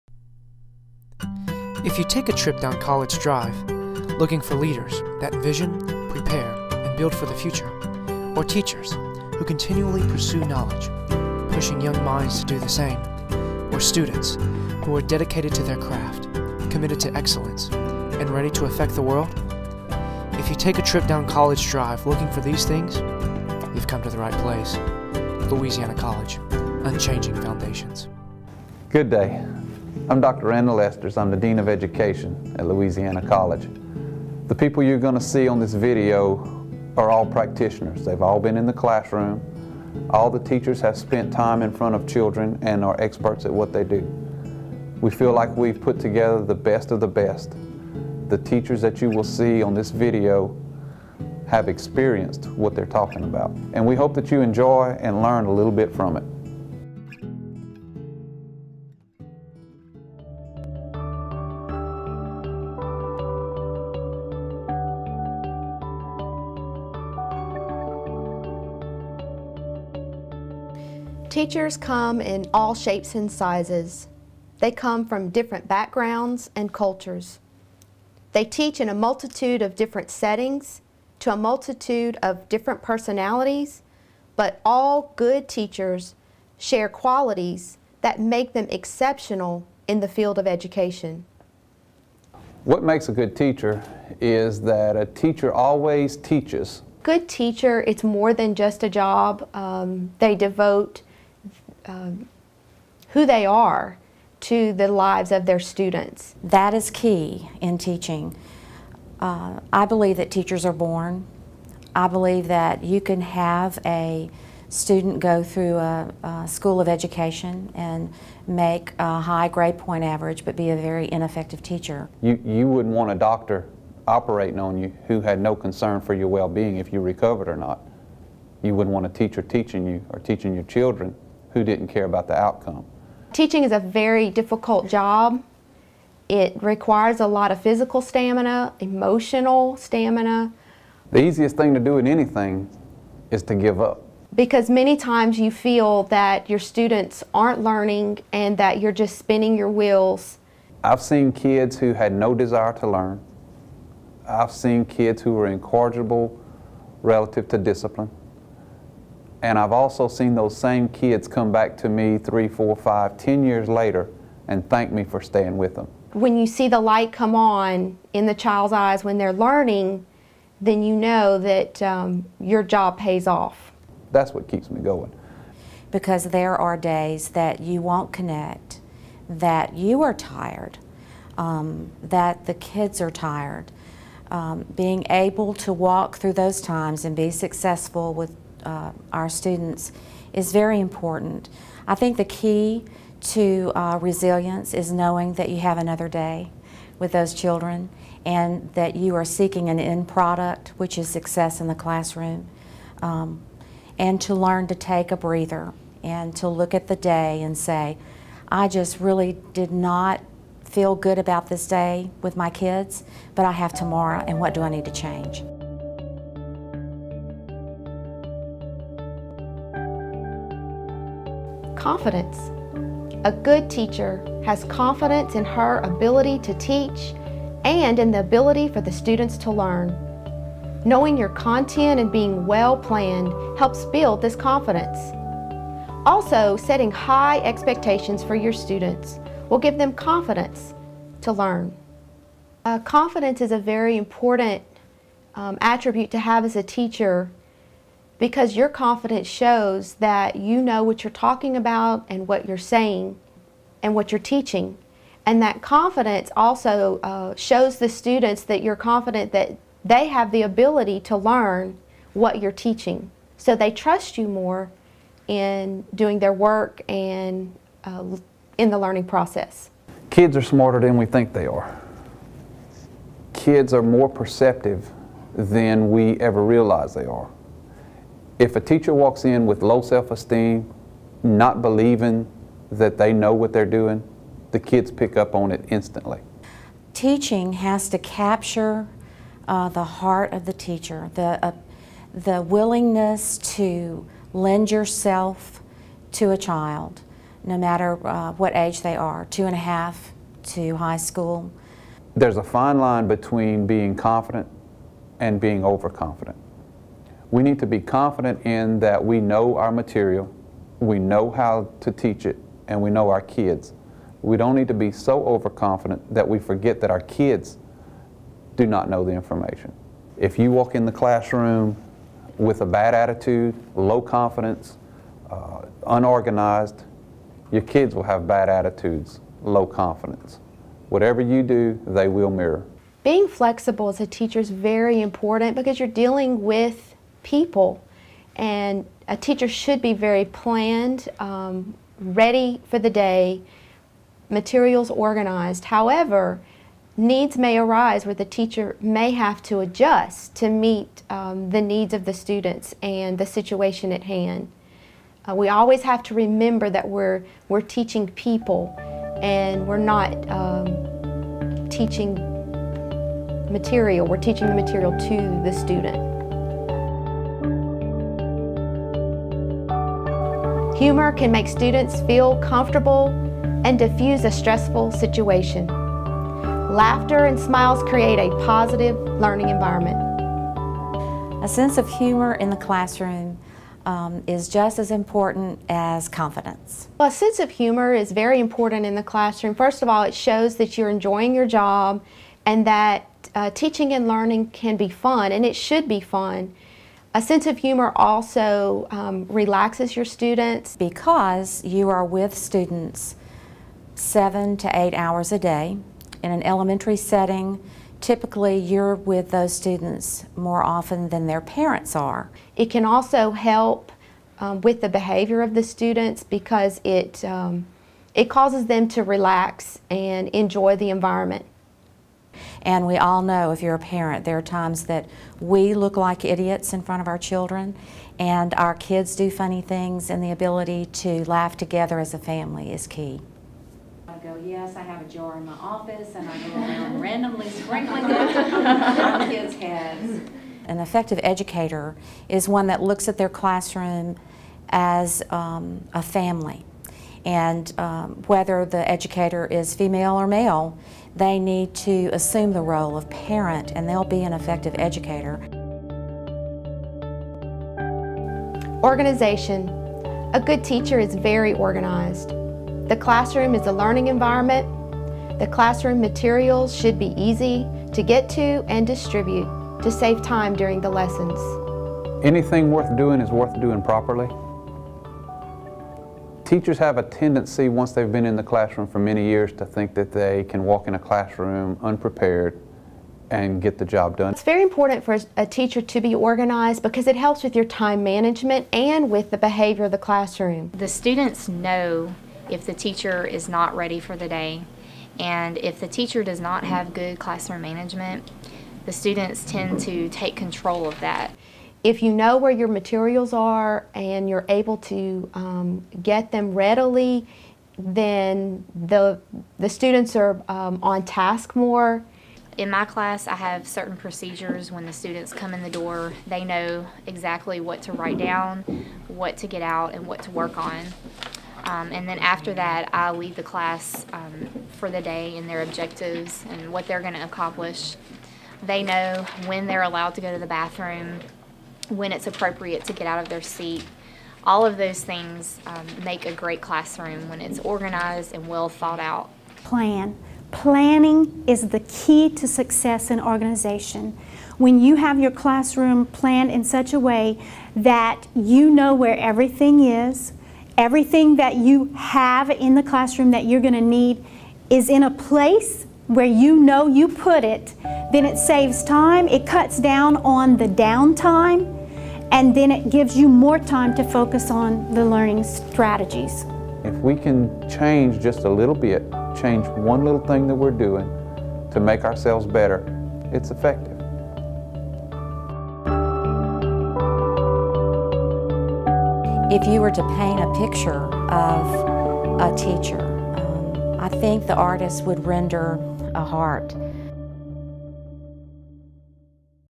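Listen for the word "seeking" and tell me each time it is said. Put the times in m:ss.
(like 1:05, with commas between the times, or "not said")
3:19.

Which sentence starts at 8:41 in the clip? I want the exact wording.
Um, and then after that, I lead the class um, for the day and their objectives and what they're going to accomplish.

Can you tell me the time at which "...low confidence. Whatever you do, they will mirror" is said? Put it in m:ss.
5:29.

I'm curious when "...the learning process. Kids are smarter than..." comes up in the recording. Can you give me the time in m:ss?
4:28.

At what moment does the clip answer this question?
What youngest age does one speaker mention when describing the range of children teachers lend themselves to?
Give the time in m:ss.
4:59.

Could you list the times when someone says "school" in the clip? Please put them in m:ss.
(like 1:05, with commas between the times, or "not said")
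1:56, 5:00.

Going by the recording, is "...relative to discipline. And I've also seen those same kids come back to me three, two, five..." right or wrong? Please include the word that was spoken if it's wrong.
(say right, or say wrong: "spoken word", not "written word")
wrong: "four", not "two".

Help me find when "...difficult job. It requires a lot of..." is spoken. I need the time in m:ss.
2:14.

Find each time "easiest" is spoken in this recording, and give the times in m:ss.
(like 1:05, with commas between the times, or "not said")
2:21.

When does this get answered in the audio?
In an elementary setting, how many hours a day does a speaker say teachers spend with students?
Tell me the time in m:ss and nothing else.
6:43.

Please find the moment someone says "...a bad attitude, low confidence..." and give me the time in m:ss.
5:22.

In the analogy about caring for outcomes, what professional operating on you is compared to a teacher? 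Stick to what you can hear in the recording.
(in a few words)
A doctor.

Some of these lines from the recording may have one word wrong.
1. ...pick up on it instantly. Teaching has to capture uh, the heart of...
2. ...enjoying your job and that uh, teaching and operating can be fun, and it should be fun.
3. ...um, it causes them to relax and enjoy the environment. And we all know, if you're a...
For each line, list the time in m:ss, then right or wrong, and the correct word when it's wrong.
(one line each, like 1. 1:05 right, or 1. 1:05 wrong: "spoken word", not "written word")
1. 4:44 right
2. 6:30 wrong: "learning", not "operating"
3. 6:57 right.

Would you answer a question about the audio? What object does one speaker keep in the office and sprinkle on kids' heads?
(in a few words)
A jar.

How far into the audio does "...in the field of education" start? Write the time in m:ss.
1:29.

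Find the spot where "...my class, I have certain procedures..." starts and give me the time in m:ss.
8:32.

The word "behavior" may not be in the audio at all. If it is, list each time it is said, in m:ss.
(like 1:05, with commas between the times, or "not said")
6:54, 8:09.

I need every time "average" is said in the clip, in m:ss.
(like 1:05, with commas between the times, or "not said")
2:00.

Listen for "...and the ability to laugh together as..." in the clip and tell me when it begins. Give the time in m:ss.
7:10.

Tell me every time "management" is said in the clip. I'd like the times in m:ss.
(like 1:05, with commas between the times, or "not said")
8:08, 8:17.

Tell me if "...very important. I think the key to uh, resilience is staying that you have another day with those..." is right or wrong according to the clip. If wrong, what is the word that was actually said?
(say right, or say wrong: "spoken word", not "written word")
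wrong: "knowing", not "staying".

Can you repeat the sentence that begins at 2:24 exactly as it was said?
Because many times you feel that your students aren't learning and that you're just spinning your wheels.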